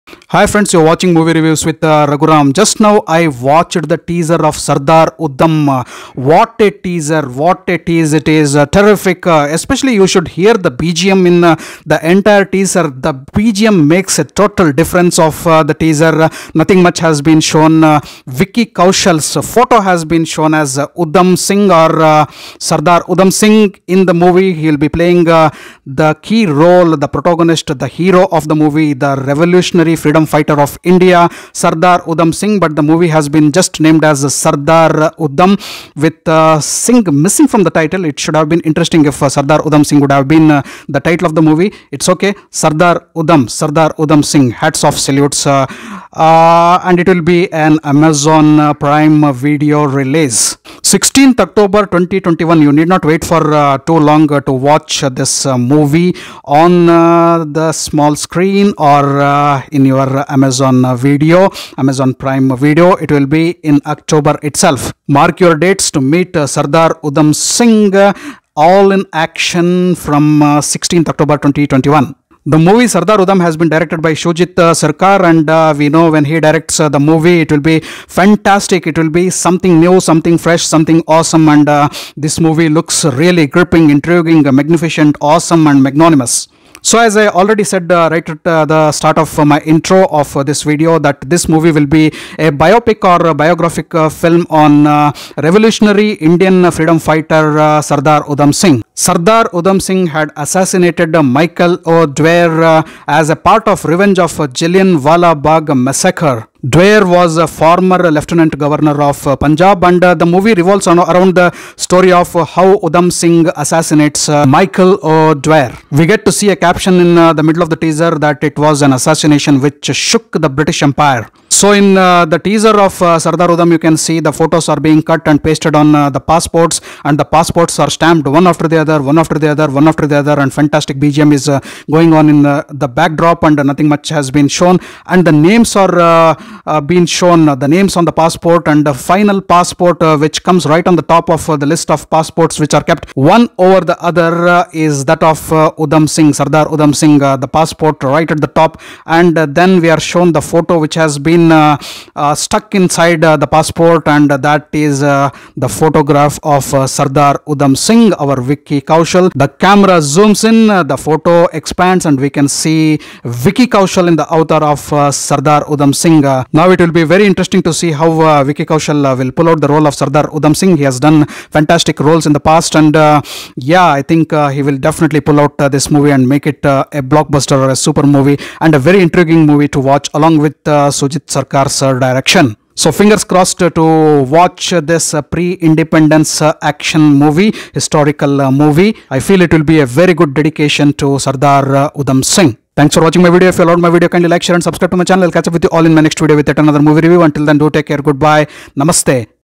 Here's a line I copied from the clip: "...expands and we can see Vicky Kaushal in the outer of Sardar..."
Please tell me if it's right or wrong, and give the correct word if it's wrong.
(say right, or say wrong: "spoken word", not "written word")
right.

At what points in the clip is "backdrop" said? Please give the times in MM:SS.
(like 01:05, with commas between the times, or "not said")
02:12.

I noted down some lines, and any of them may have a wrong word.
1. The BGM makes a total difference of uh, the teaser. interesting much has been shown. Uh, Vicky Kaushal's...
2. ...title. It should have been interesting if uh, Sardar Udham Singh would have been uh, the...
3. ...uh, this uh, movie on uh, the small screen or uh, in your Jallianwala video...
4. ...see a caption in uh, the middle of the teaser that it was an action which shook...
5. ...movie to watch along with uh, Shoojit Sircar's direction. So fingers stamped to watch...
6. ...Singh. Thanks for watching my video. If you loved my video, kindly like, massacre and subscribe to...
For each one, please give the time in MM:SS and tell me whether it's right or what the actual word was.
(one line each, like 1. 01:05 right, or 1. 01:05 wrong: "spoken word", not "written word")
1. 00:12 wrong: "nothing", not "interesting"
2. 00:37 right
3. 00:55 wrong: "Amazon", not "Jallianwala"
4. 01:56 wrong: "assassination", not "action"
5. 02:59 wrong: "crossed", not "stamped"
6. 03:12 wrong: "share", not "massacre".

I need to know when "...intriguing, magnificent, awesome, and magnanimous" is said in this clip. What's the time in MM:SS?
01:23.